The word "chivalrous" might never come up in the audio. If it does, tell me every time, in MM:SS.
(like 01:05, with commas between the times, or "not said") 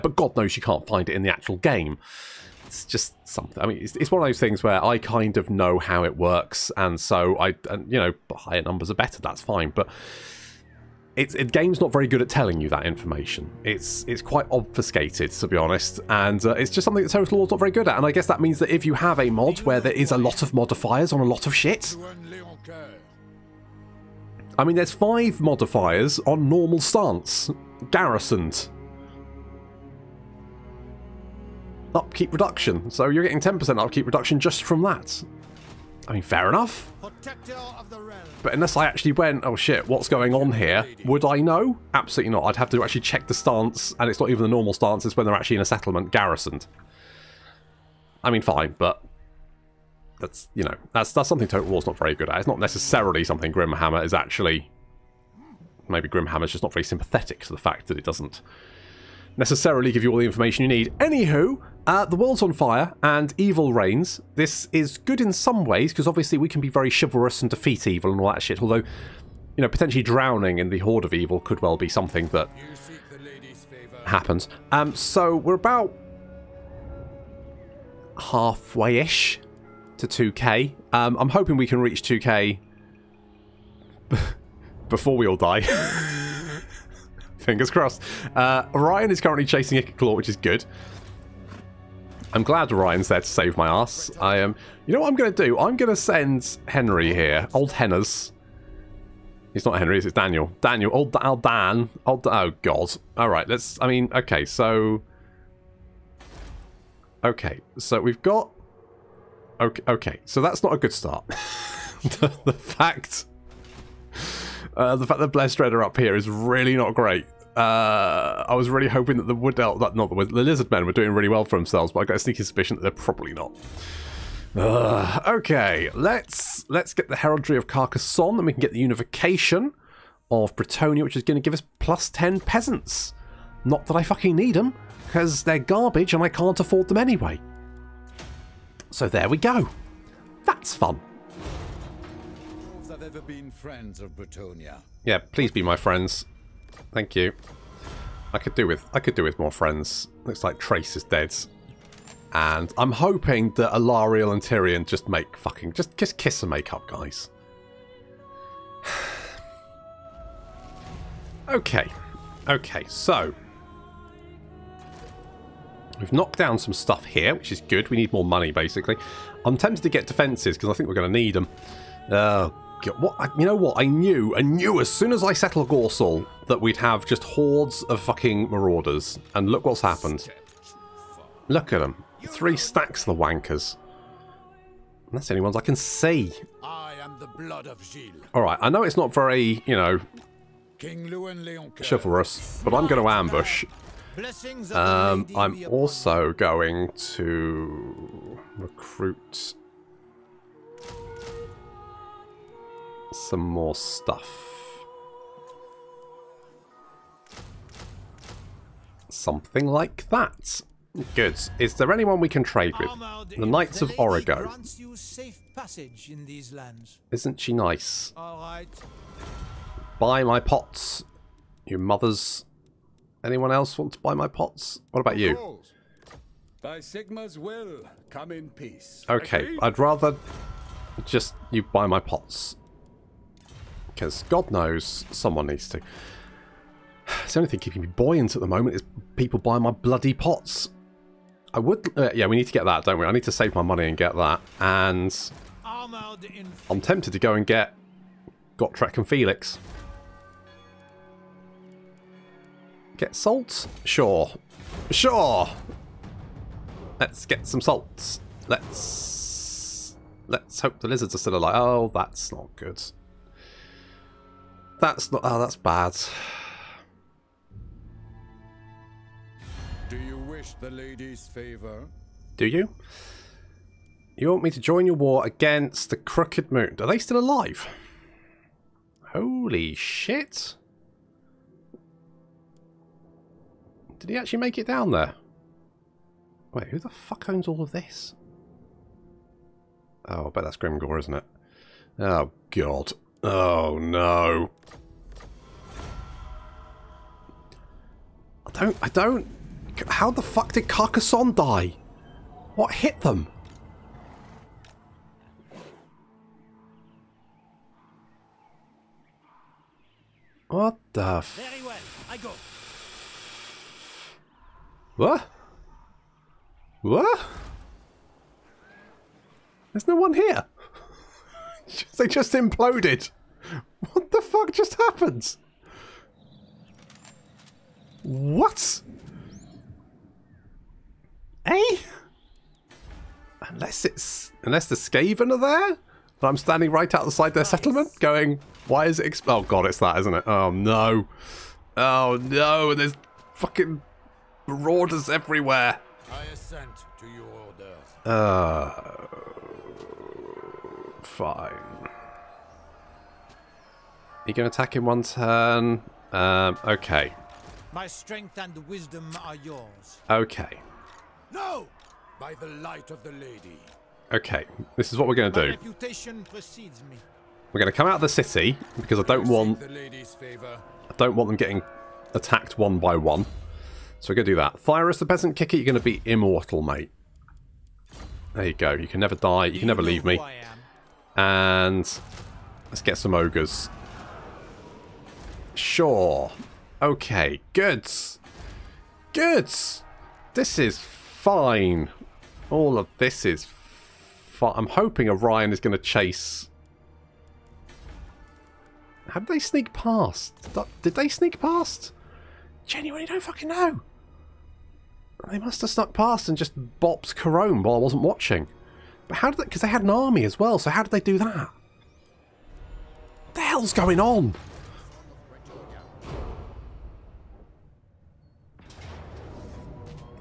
01:06, 03:11.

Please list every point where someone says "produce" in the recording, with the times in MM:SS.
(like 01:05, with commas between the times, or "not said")
not said.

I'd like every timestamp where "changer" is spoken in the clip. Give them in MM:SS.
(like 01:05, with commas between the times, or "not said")
not said.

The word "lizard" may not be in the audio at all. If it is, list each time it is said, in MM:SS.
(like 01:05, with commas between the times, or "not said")
02:00, 04:20.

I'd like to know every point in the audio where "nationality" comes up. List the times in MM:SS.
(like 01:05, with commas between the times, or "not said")
not said.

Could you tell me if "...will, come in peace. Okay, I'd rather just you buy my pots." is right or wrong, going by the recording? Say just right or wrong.
right.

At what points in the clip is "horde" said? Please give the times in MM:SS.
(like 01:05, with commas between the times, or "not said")
01:10, 02:57.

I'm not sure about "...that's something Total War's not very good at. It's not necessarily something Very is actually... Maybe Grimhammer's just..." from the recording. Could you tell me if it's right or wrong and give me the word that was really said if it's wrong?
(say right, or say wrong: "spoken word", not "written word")
wrong: "Grimhammer", not "Very".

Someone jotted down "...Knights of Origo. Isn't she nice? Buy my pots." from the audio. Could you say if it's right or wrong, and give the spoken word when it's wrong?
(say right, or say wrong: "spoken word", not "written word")
right.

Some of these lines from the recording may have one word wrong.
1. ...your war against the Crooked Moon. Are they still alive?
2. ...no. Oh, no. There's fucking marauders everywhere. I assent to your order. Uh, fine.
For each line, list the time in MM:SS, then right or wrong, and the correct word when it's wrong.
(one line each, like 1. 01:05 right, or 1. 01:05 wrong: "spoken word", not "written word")
1. 04:34 right
2. 05:40 right.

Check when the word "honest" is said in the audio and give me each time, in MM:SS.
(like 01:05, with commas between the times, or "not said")
00:15.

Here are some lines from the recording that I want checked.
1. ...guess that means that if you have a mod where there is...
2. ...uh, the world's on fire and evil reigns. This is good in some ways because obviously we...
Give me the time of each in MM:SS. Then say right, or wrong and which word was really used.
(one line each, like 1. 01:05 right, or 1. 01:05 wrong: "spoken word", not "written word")
1. 00:18 right
2. 01:01 right.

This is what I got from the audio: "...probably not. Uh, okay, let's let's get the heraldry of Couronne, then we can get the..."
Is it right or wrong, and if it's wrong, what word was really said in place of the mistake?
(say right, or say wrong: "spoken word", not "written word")
wrong: "Carcassonne", not "Couronne".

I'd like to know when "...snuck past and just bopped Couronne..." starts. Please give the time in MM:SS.
06:45.